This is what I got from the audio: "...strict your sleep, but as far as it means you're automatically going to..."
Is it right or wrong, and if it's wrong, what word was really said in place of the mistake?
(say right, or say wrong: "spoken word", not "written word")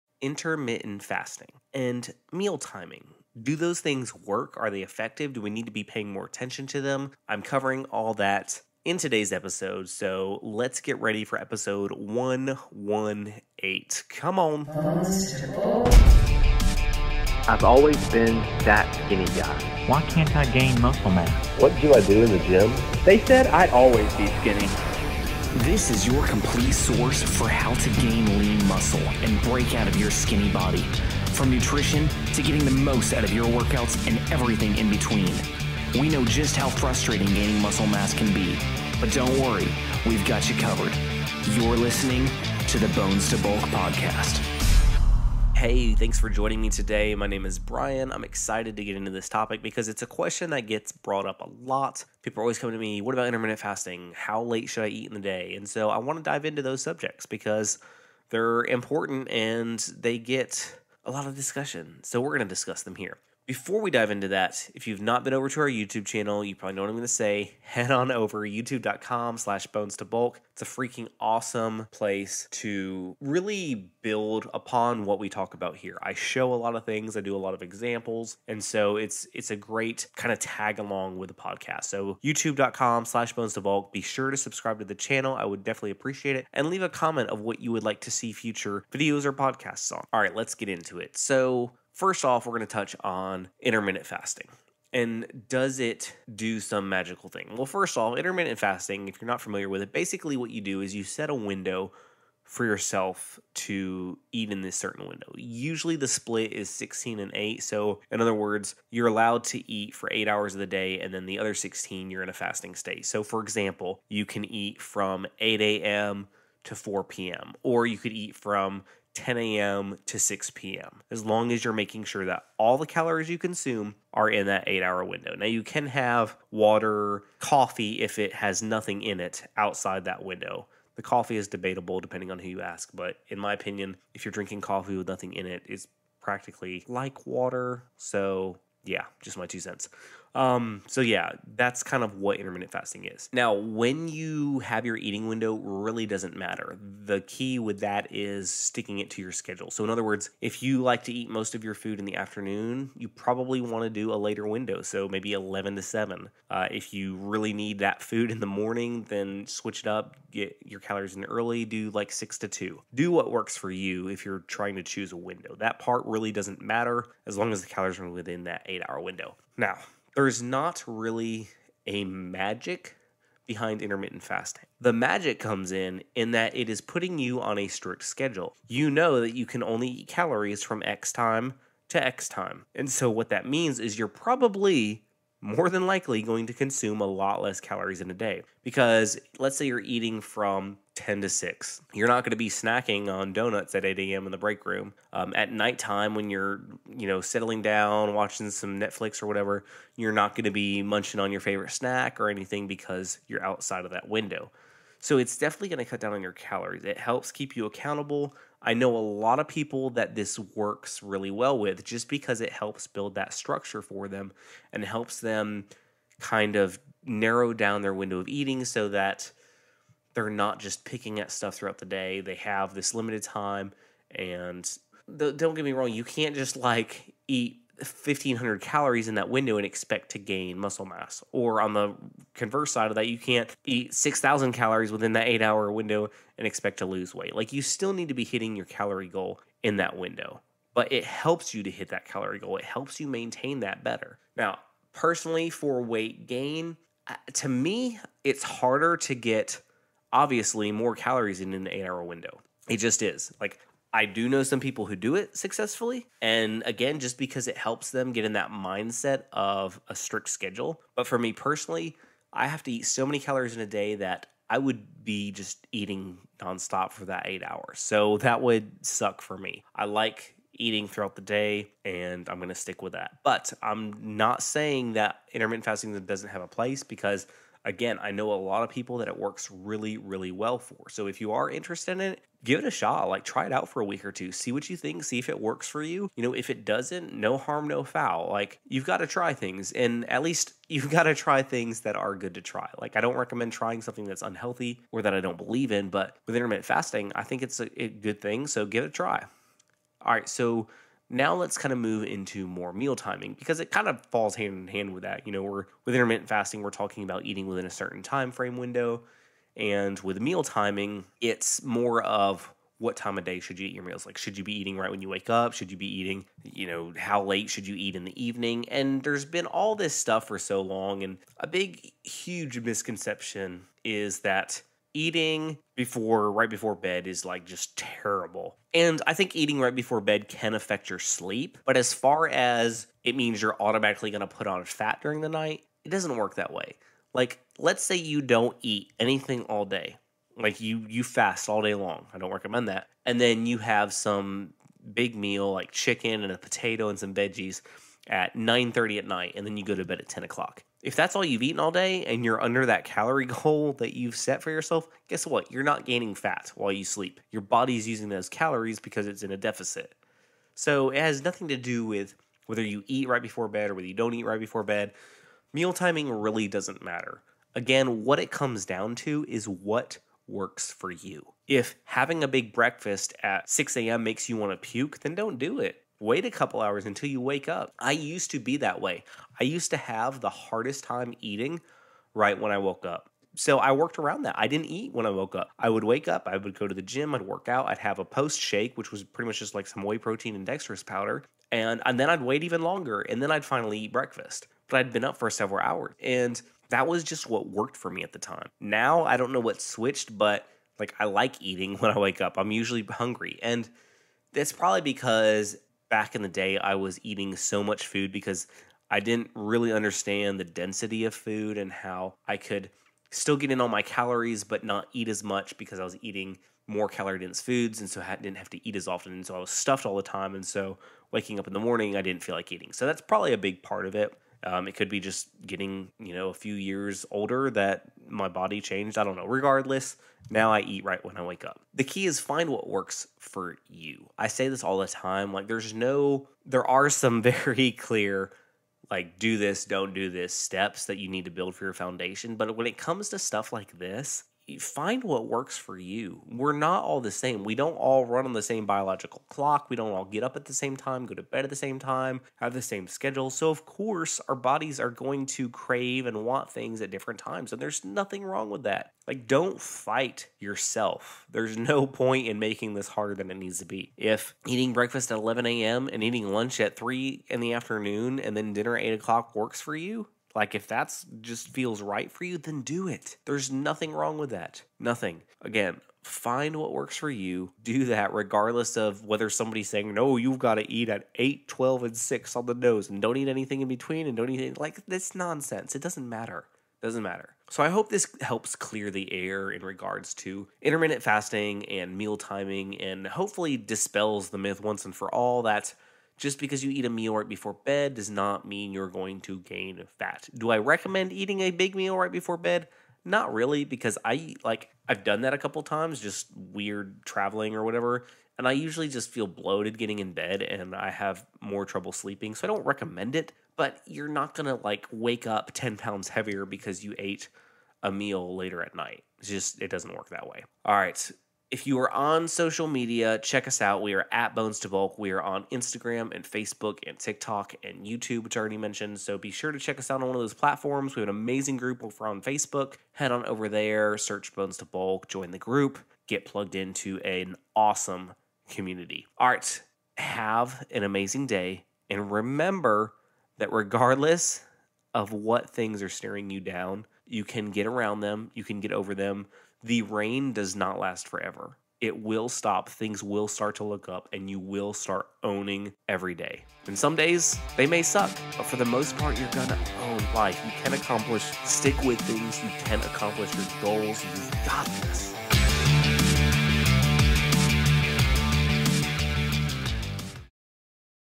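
wrong: "affect", not "strict".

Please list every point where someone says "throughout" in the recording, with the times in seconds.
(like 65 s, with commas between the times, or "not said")
221 s, 270 s.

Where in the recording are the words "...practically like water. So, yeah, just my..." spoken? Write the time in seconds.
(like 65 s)
136 s.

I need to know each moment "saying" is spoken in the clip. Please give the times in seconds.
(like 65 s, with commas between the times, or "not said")
274 s, 479 s.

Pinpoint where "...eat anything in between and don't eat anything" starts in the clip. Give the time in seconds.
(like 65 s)
483 s.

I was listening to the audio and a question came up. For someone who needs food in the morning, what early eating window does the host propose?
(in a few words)
6 to 2.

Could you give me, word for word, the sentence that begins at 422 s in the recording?
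So that's probably a big part of it.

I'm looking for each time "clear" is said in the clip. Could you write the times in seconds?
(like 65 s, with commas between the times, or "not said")
437 s, 488 s.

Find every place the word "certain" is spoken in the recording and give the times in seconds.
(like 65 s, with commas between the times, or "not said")
104 s, 307 s.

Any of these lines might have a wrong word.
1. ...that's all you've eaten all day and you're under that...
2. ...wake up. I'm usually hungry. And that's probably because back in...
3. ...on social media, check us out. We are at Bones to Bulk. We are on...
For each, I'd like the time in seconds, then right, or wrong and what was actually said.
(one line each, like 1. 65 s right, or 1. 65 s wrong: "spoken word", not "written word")
1. 350 s right
2. 401 s right
3. 521 s right.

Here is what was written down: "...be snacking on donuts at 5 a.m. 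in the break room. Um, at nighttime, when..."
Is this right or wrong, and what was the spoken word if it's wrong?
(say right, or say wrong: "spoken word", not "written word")
wrong: "8", not "5".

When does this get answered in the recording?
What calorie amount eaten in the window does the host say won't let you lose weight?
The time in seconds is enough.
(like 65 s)
233 s.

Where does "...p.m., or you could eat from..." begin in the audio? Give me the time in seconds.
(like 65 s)
117 s.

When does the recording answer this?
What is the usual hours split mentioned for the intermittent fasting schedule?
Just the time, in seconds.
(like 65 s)
106 s.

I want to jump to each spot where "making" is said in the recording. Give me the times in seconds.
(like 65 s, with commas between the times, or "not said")
121 s, 462 s.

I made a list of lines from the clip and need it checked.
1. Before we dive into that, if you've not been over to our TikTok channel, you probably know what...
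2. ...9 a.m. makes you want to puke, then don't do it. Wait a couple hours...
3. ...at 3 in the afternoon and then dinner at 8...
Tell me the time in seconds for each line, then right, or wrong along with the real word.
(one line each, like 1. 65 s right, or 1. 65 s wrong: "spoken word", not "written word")
1. 63 s wrong: "YouTube", not "TikTok"
2. 373 s wrong: "6", not "9"
3. 466 s right.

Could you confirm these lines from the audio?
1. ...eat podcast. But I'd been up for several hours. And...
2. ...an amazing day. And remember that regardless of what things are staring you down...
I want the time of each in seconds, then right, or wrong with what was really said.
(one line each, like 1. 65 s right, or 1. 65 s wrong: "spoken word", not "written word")
1. 393 s wrong: "breakfast", not "podcast"
2. 540 s right.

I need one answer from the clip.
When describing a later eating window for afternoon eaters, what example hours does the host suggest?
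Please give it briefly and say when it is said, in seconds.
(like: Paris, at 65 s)
11 to 7, at 155 s.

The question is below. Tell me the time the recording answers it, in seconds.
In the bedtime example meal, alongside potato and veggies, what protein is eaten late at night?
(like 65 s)
345 s.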